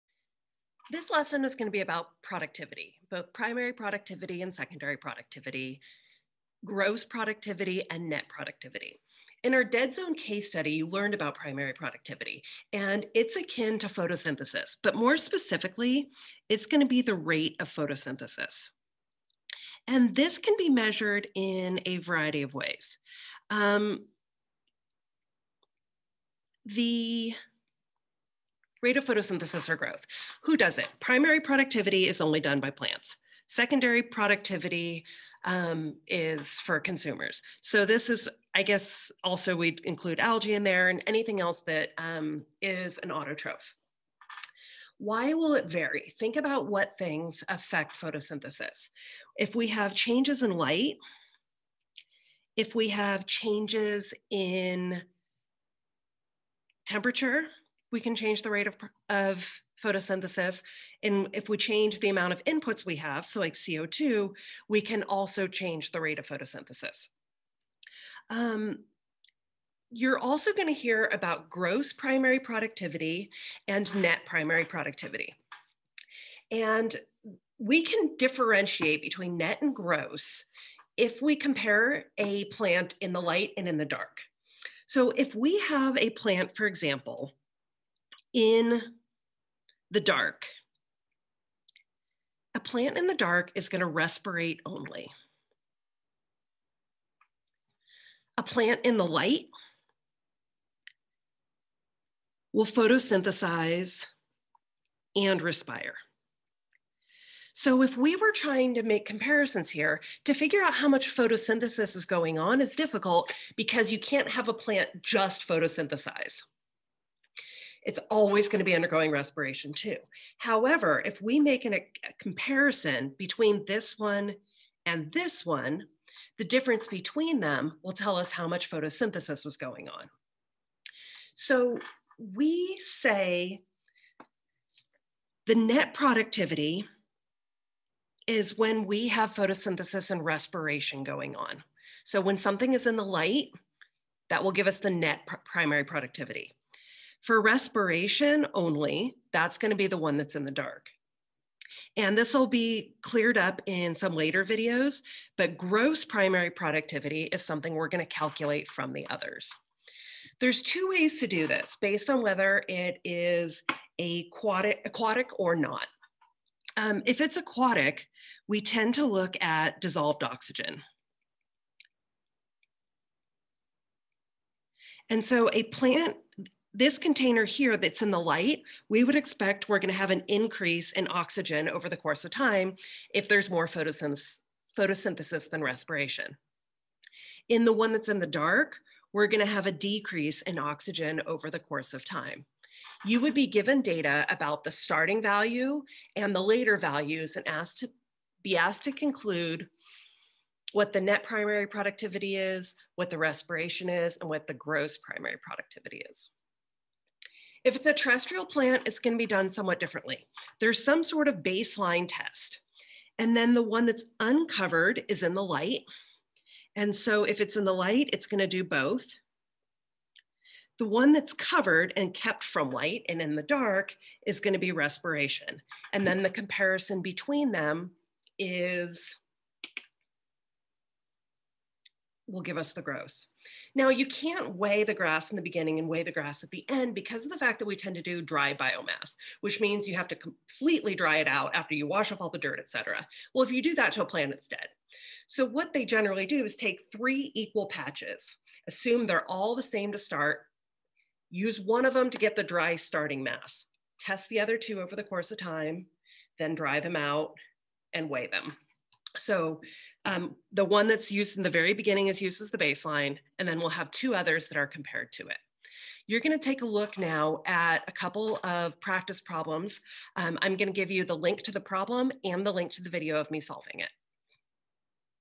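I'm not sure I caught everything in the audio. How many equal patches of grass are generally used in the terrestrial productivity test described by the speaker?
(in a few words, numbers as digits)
3.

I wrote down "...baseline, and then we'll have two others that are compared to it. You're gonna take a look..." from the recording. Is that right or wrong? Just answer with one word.
right.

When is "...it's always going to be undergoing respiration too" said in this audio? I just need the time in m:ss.
1:57.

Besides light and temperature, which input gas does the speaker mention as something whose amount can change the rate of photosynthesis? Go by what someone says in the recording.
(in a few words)
CO2.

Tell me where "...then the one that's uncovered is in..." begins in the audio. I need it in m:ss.
3:33.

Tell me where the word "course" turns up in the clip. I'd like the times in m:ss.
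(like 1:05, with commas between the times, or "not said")
3:01, 3:11, 4:15.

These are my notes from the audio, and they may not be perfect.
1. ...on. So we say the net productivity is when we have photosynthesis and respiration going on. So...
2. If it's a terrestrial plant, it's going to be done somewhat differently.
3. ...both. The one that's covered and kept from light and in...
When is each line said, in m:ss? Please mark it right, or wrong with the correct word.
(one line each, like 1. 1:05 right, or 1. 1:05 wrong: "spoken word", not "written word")
1. 2:09 right
2. 3:27 right
3. 3:38 right.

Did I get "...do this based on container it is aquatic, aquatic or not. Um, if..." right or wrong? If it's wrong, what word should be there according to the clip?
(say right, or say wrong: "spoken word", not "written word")
wrong: "whether", not "container".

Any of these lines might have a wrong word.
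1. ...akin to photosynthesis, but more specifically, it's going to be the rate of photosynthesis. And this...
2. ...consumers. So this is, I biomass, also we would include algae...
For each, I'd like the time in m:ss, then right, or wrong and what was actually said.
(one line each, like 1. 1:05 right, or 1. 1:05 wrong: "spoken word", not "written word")
1. 0:13 right
2. 0:36 wrong: "guess", not "biomass".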